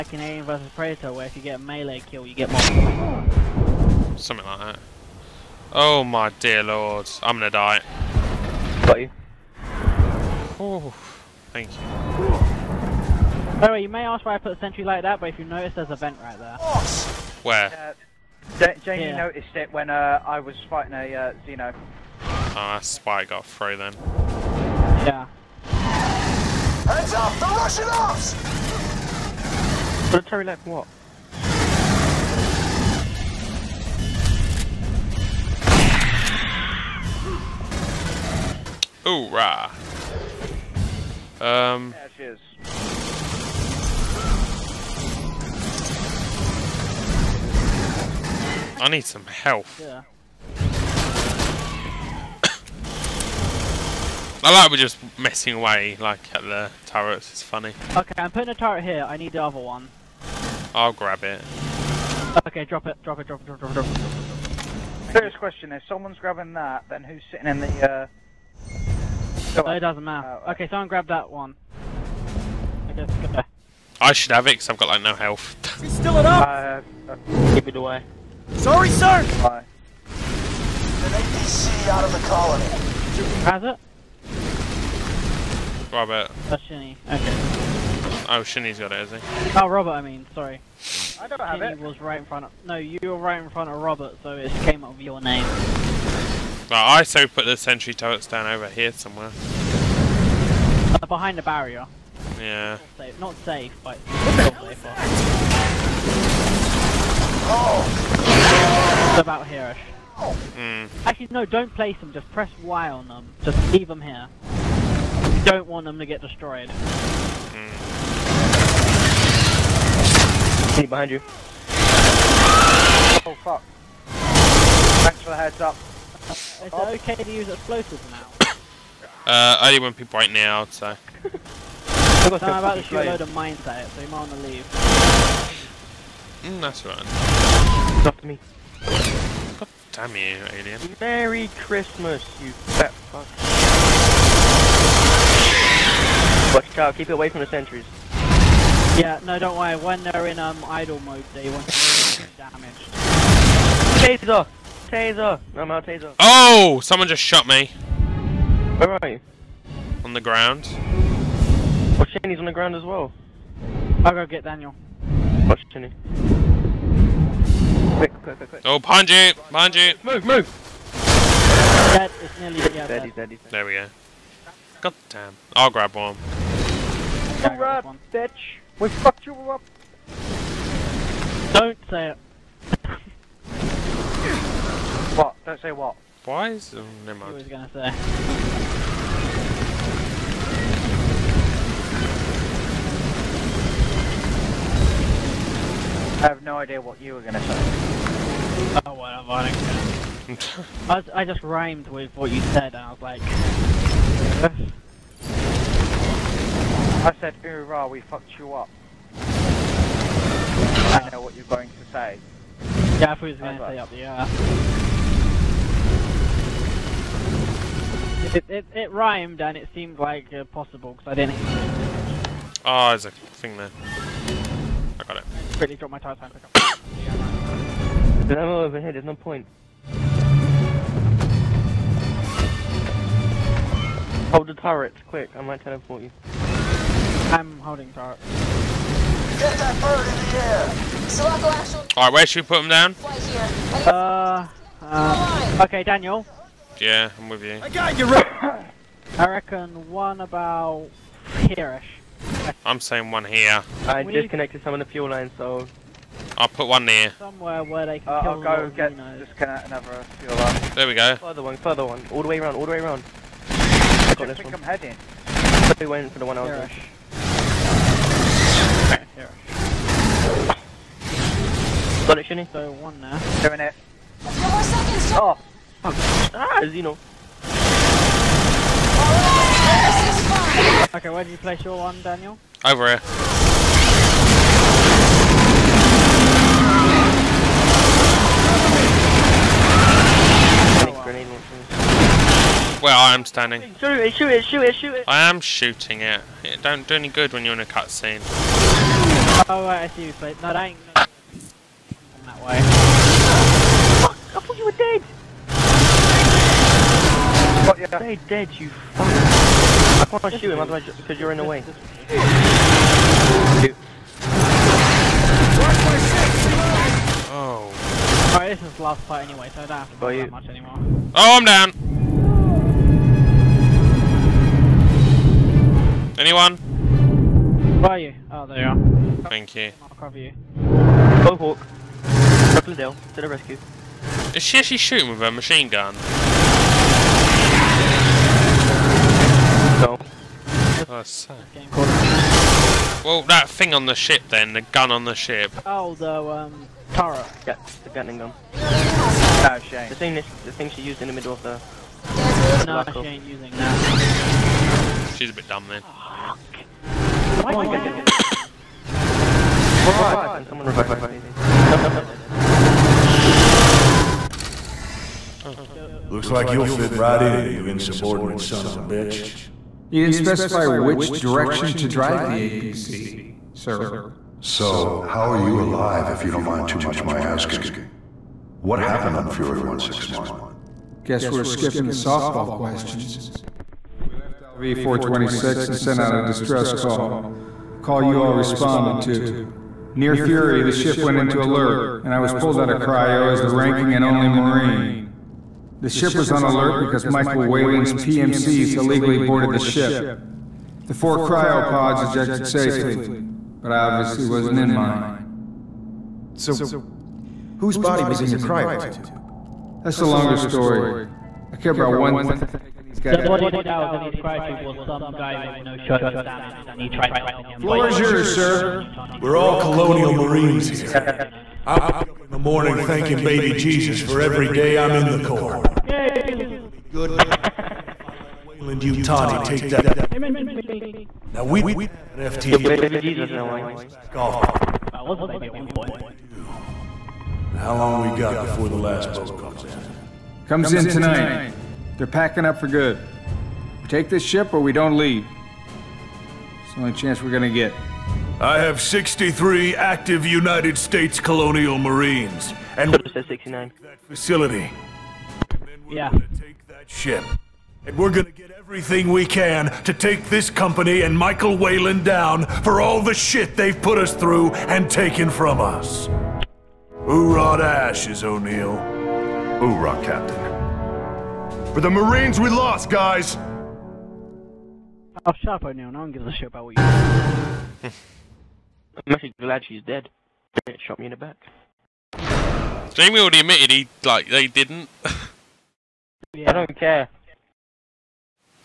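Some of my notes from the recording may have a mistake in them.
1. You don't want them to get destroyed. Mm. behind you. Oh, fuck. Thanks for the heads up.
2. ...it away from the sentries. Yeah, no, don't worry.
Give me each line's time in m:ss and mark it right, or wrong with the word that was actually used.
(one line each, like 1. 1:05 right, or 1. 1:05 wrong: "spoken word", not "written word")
1. 1:54 right
2. 2:27 right.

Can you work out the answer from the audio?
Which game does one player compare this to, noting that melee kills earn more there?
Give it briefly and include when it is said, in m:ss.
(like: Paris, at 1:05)
Alien vs Predator, at 0:00.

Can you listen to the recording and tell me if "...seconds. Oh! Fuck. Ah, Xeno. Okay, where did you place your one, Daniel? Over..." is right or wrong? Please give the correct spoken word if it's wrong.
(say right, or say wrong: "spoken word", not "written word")
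right.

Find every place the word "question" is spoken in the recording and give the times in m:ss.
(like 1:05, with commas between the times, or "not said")
1:05, 6:22.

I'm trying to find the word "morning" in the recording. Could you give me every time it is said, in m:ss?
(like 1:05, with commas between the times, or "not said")
7:02.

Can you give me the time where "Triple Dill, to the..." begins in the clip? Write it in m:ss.
5:32.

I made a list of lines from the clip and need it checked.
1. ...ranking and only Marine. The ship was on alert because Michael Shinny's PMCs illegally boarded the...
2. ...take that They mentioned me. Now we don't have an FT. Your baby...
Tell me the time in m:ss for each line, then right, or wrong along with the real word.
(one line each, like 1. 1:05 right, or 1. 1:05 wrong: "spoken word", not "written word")
1. 6:33 wrong: "Weyland", not "Shinny"
2. 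7:09 right.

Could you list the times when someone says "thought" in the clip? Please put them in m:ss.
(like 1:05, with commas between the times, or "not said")
3:33, 5:04.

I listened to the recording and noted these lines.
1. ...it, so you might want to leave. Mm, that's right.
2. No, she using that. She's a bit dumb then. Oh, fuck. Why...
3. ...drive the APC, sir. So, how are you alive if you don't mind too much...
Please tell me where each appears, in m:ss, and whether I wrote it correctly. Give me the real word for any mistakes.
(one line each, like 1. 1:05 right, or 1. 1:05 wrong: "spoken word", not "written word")
1. 2:13 right
2. 5:52 right
3. 6:11 right.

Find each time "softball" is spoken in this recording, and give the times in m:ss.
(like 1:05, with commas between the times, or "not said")
6:21.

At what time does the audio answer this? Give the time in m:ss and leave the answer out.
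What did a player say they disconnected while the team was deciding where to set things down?
4:14.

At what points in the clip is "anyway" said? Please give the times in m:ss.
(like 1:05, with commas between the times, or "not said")
5:19.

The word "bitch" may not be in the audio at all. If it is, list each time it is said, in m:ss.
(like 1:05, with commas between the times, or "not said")
2:58, 6:08.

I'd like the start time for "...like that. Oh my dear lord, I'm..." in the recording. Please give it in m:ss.
0:04.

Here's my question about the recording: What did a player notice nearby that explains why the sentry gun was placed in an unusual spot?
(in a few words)
a vent.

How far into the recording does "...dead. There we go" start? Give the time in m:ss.
2:53.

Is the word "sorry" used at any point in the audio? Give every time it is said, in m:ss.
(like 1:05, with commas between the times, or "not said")
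1:18, 1:30.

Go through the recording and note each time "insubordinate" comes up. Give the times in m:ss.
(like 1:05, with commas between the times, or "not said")
6:07.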